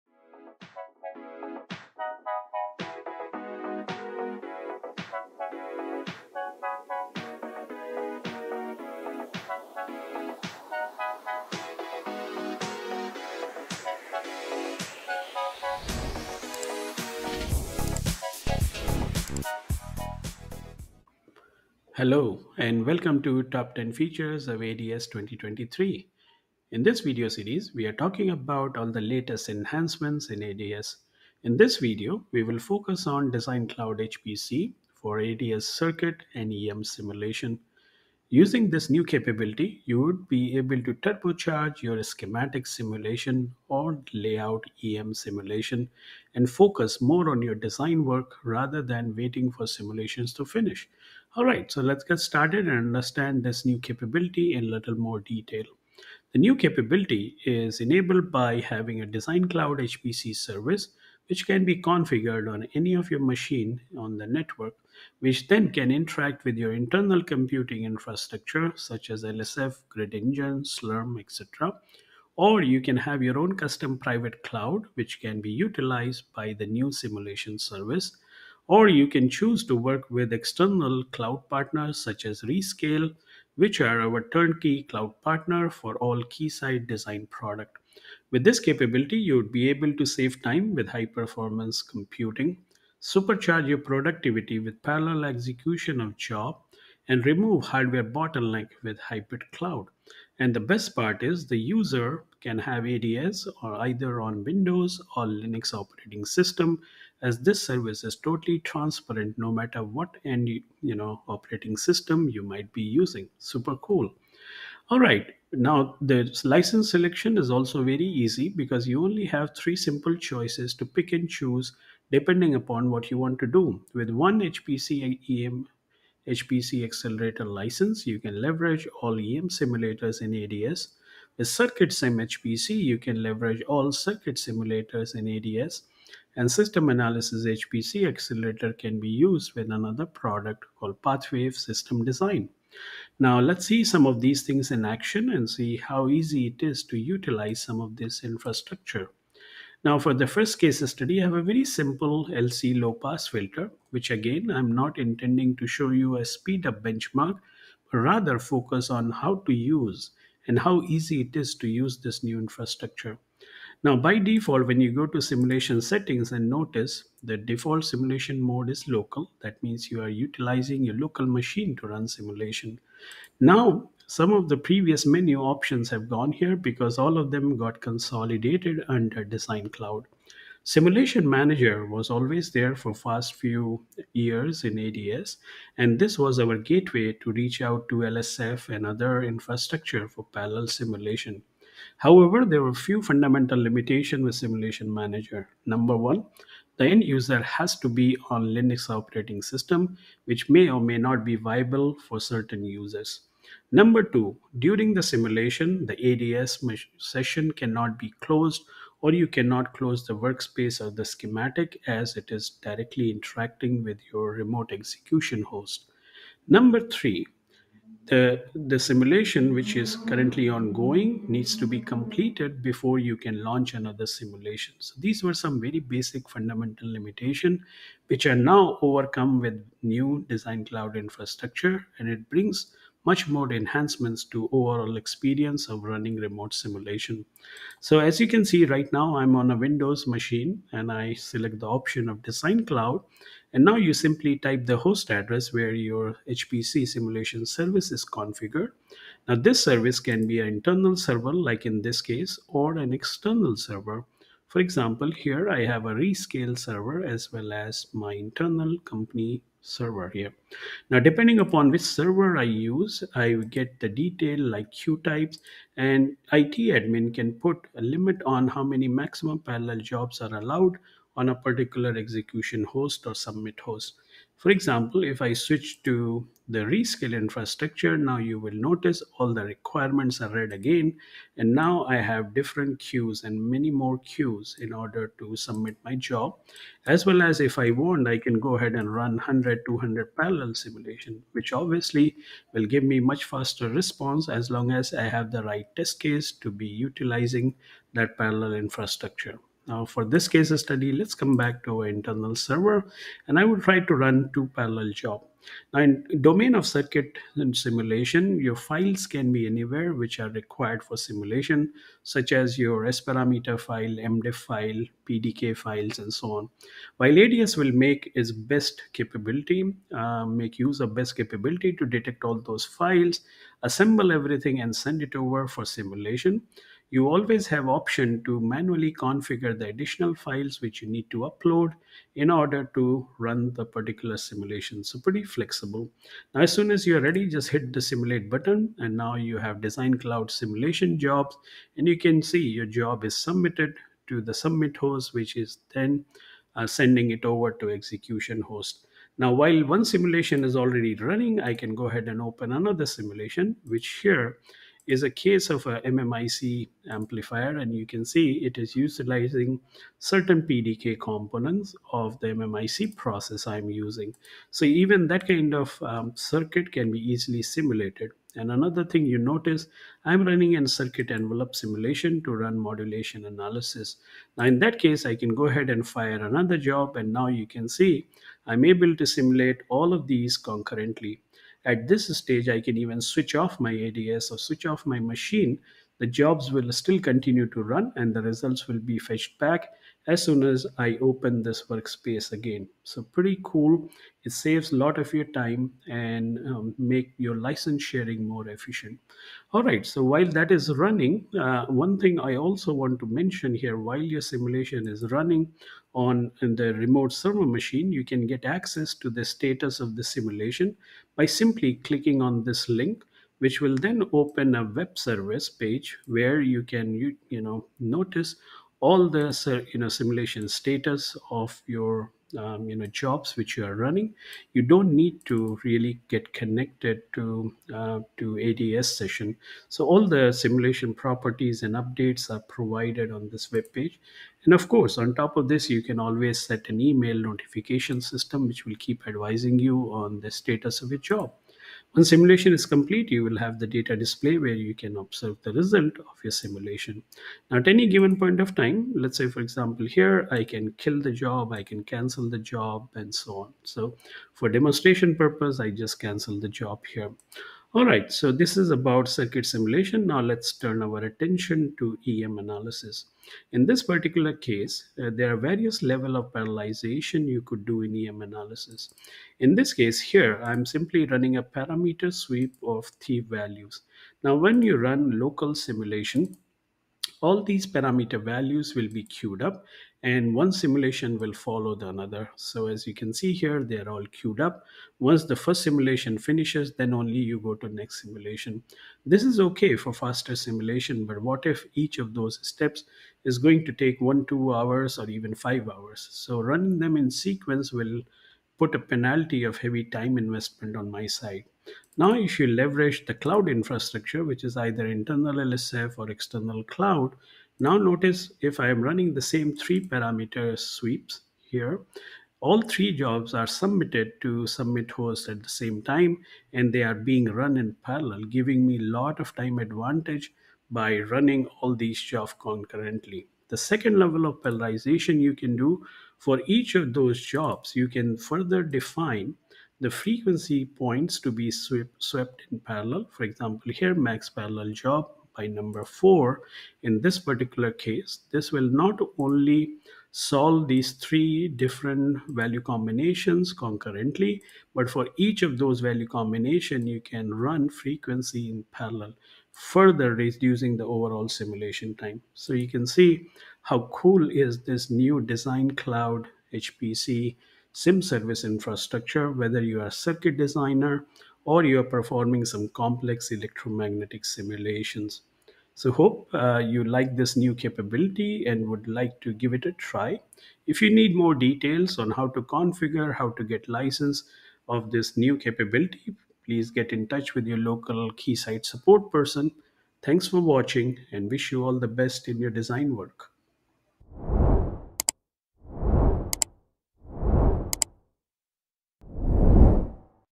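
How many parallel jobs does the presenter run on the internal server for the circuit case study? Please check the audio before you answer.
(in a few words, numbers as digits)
2.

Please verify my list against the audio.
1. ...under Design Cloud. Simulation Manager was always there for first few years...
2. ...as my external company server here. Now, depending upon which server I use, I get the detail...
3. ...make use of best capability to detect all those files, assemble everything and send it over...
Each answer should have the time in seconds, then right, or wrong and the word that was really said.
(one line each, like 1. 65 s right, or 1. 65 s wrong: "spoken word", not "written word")
1. 178 s right
2. 257 s wrong: "internal", not "external"
3. 320 s right.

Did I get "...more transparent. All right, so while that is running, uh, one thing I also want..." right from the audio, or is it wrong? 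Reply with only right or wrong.
wrong.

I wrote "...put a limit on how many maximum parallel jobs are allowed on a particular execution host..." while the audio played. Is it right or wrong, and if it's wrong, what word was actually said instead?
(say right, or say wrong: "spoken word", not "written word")
right.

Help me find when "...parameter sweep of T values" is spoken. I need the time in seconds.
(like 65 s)
471 s.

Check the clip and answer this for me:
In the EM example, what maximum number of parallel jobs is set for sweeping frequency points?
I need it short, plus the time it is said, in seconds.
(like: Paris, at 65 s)
4, at 535 s.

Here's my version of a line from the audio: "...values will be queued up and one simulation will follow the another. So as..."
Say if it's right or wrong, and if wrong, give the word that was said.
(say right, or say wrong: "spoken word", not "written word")
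right.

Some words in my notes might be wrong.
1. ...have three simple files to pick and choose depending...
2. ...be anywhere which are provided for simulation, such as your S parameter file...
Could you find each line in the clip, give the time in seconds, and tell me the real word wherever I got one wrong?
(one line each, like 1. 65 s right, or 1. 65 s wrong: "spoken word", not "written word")
1. 119 s wrong: "choices", not "files"
2. 309 s wrong: "required", not "provided".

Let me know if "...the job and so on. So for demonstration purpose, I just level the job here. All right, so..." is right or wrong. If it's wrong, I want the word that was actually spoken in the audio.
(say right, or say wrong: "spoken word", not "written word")
wrong: "cancel", not "level".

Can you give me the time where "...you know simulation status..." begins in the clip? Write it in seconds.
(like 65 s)
419 s.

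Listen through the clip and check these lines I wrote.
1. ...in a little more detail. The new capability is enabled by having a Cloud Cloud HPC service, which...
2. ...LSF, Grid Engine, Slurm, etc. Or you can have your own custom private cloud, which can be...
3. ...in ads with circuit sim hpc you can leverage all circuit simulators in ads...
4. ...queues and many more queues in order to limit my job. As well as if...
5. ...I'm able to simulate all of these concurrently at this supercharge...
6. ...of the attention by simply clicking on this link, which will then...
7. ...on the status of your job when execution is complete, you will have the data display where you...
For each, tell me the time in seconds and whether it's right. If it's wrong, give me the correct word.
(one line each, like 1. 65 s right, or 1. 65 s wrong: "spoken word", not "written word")
1. 54 s wrong: "Design", not "Cloud"
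2. 69 s right
3. 130 s right
4. 282 s wrong: "submit", not "limit"
5. 378 s wrong: "stage", not "supercharge"
6. 409 s wrong: "simulation", not "attention"
7. 439 s wrong: "simulation", not "execution".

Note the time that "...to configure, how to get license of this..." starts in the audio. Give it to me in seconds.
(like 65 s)
572 s.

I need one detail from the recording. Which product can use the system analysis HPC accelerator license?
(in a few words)
Pathwave System Design.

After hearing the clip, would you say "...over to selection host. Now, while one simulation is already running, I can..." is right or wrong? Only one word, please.
wrong.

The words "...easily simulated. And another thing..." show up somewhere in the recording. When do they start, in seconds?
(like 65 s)
366 s.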